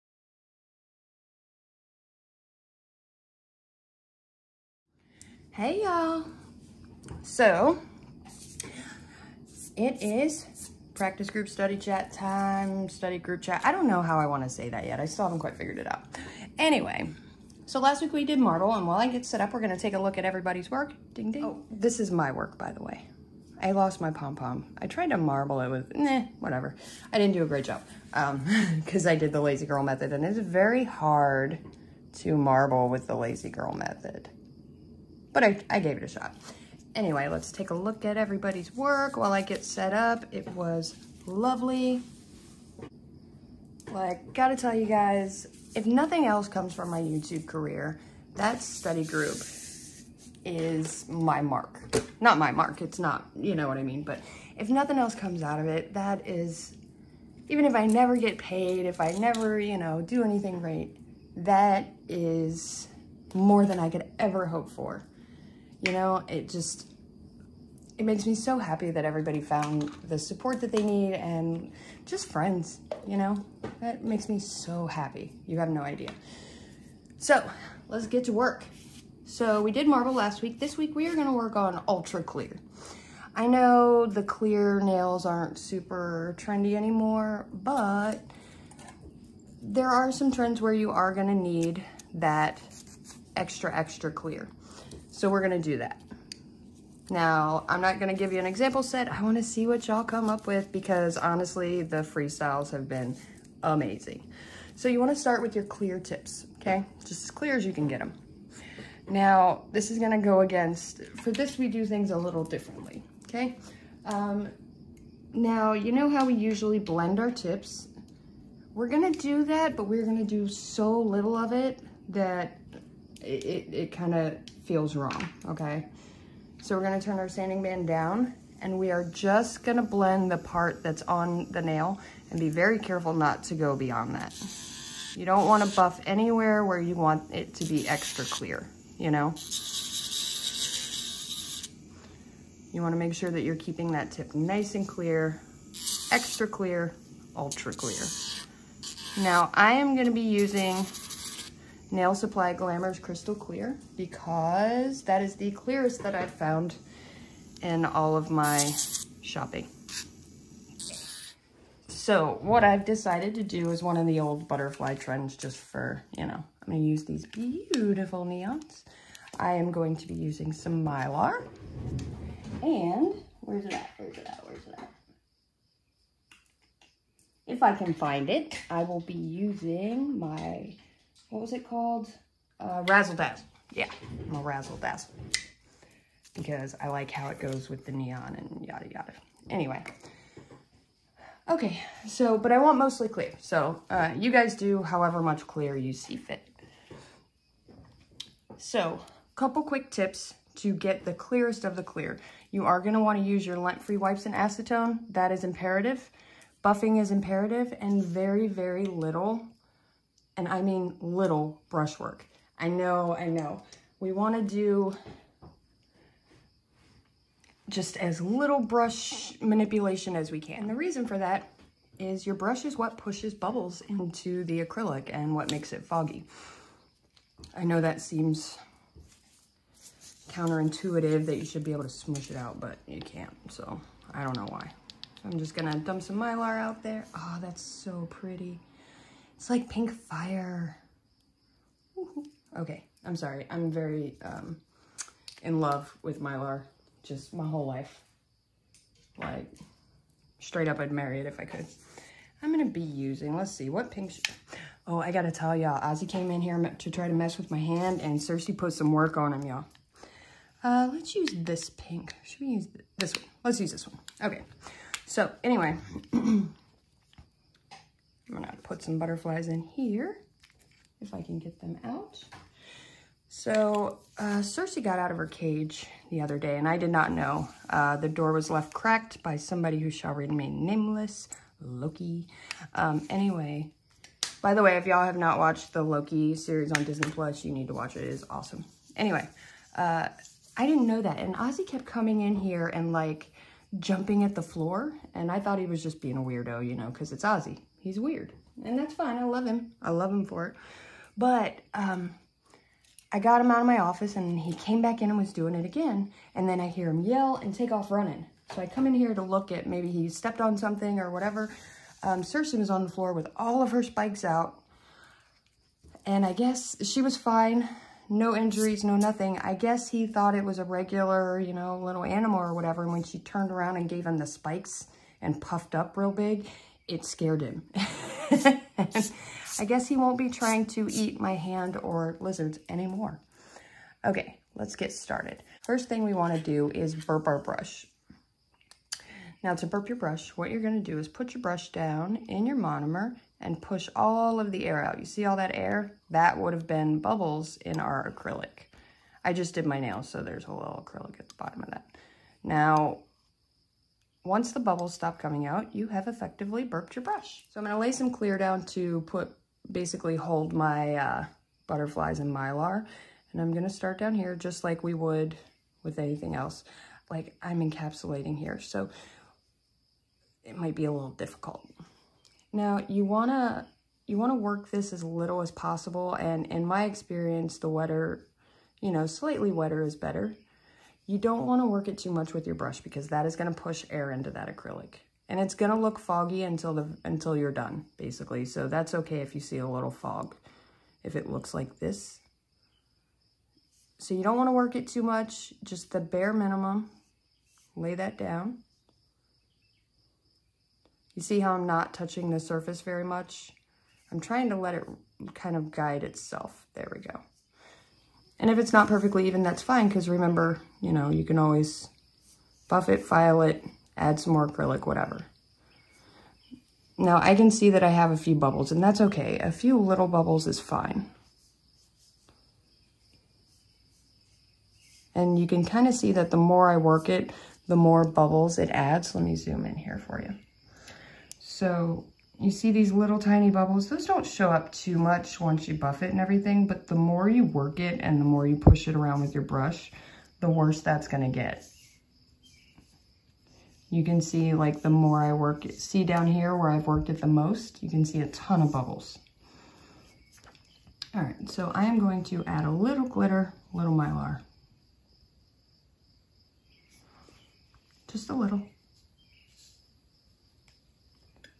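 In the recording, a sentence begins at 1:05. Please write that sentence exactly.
You know, it just, it makes me so happy that everybody found the support that they need and just friends, you know?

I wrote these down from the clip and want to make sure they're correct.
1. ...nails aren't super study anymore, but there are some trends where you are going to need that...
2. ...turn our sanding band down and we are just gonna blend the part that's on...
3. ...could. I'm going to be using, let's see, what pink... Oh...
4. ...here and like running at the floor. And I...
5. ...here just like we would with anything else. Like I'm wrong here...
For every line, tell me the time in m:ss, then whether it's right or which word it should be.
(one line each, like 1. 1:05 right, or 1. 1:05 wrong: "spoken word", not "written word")
1. 1:24 wrong: "trendy", not "study"
2. 2:07 right
3. 4:11 right
4. 4:52 wrong: "jumping", not "running"
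5. 6:04 wrong: "encapsulating", not "wrong".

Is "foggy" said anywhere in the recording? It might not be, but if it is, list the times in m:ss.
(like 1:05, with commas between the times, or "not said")
3:45, 6:25.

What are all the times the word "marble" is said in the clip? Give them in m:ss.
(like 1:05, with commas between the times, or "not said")
0:18, 0:25, 0:32, 1:19.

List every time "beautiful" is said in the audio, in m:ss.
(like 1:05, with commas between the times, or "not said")
2:47.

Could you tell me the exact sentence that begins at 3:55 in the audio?
So I'm just gonna dump some Mylar out there.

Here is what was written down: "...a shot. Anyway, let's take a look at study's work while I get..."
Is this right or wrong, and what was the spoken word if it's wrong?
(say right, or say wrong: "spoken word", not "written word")
wrong: "everybody", not "study".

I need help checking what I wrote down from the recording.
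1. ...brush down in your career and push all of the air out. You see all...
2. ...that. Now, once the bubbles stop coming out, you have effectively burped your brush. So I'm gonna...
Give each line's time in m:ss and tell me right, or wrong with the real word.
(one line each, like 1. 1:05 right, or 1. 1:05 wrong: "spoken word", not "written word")
1. 5:41 wrong: "monomer", not "career"
2. 5:51 right.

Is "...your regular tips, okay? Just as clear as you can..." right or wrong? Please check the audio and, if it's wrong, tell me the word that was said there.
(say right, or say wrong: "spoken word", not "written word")
wrong: "clear", not "regular".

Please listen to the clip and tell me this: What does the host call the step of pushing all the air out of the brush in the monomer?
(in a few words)
Burp our brush.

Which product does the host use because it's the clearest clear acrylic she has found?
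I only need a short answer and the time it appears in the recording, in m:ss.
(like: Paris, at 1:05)
Nail Supply Glamour's Crystal Clear, at 2:31.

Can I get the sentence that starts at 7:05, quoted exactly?
And you can kind of see that the more I work it, the more bubbles it adds.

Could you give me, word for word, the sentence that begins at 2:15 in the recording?
You don't wanna buff anywhere where you want it to be extra clear, you know?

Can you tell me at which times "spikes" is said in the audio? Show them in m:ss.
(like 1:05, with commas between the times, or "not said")
5:13, 5:24.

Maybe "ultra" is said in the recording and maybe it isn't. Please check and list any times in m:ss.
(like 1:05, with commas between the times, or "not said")
1:21, 2:27.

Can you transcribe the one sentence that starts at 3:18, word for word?
So, couple quick tips to get the clearest of the clear.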